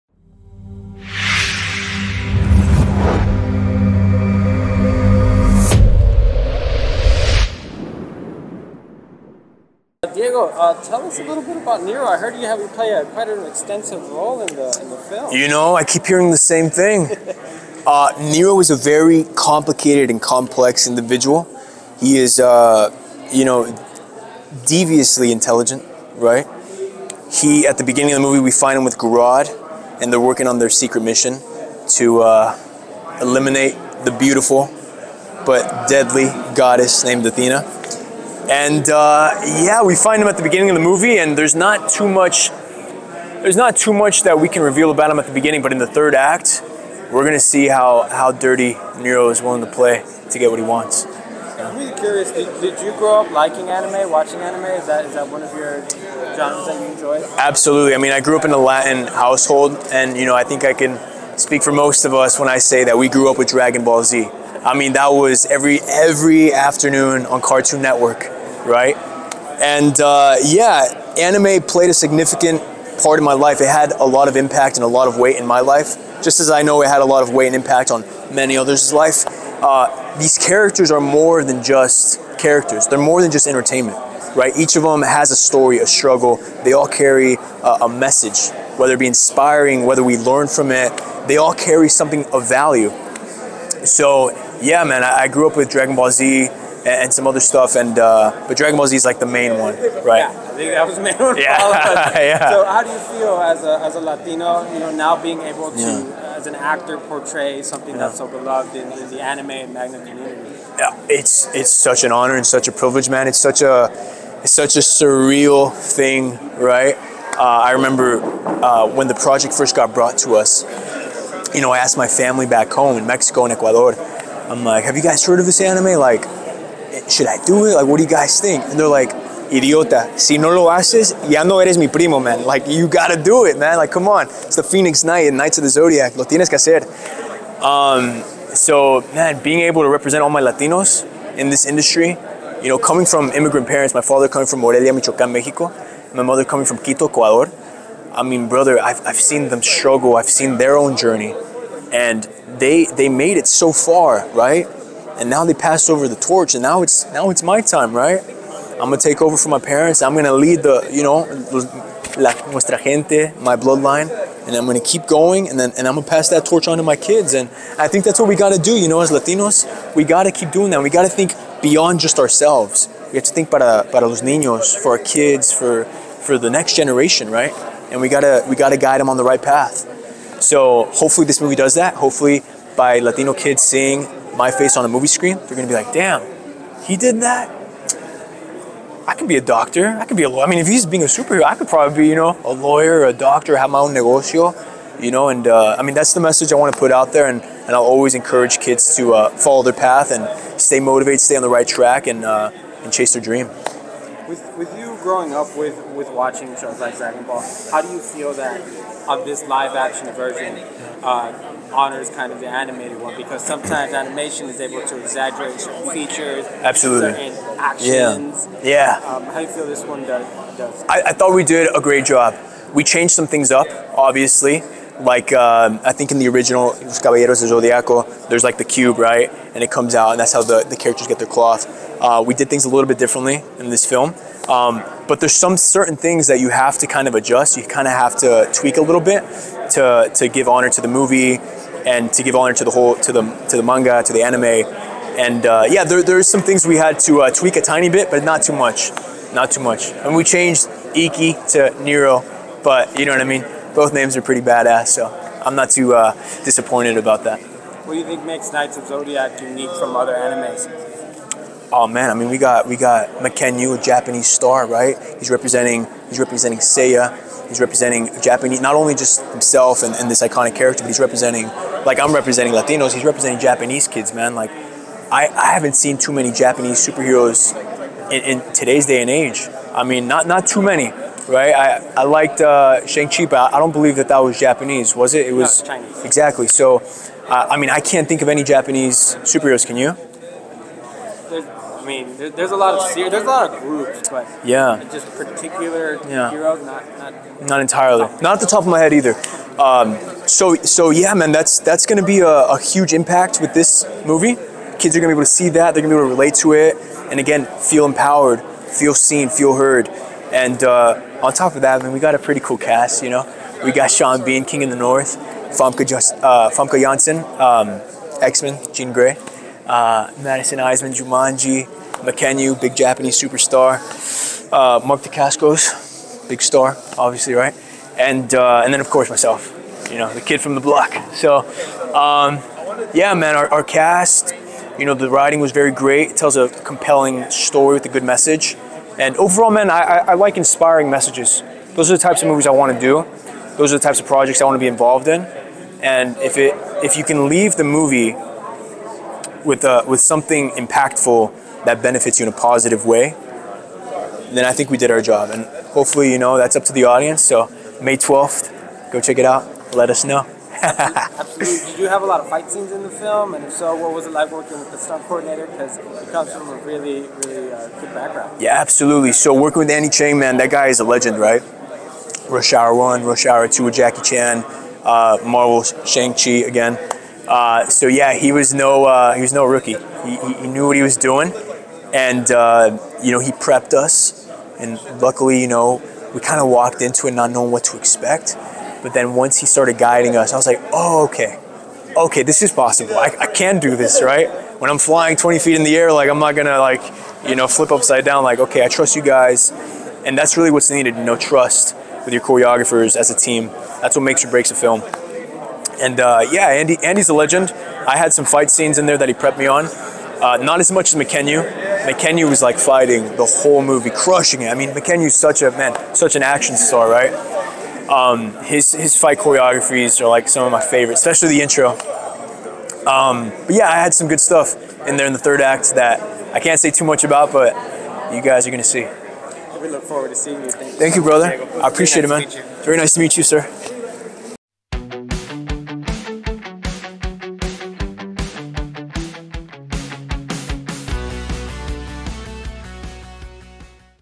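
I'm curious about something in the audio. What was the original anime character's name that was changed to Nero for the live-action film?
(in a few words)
Ikki.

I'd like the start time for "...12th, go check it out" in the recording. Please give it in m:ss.
5:57.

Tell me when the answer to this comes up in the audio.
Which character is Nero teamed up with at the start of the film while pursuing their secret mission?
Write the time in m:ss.
0:28.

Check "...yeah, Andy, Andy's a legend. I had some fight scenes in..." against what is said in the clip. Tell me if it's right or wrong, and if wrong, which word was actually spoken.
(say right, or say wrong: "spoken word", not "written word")
right.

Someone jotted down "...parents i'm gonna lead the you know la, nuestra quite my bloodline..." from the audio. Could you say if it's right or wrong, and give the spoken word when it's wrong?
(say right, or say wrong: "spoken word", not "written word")
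wrong: "gente", not "quite".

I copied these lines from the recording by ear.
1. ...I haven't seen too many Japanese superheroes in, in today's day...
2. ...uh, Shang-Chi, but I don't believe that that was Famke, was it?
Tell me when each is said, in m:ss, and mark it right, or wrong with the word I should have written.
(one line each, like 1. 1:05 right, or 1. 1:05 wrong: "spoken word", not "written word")
1. 4:35 right
2. 4:42 wrong: "Japanese", not "Famke".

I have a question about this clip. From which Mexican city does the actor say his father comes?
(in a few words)
Morelia.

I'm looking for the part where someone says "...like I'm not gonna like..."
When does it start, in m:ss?
6:35.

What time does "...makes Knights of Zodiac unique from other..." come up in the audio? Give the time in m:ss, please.
4:18.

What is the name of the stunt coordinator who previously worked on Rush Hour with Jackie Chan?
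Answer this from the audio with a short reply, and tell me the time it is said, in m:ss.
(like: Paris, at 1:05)
Andy Cheng, at 6:09.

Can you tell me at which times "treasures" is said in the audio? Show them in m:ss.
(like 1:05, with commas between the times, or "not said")
not said.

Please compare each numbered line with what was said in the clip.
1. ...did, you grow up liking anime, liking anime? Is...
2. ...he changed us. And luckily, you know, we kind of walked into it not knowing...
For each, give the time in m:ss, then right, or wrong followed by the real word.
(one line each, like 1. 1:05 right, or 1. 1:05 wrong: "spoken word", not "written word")
1. 0:52 wrong: "watching", not "liking"
2. 6:23 wrong: "prepped", not "changed".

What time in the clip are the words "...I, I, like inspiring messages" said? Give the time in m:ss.
5:39.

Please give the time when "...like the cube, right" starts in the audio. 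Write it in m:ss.
3:48.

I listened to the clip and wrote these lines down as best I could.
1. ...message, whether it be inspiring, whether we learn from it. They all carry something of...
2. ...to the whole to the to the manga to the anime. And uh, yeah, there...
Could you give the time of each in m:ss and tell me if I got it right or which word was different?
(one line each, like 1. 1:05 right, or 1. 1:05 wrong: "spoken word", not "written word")
1. 1:27 right
2. 4:02 right.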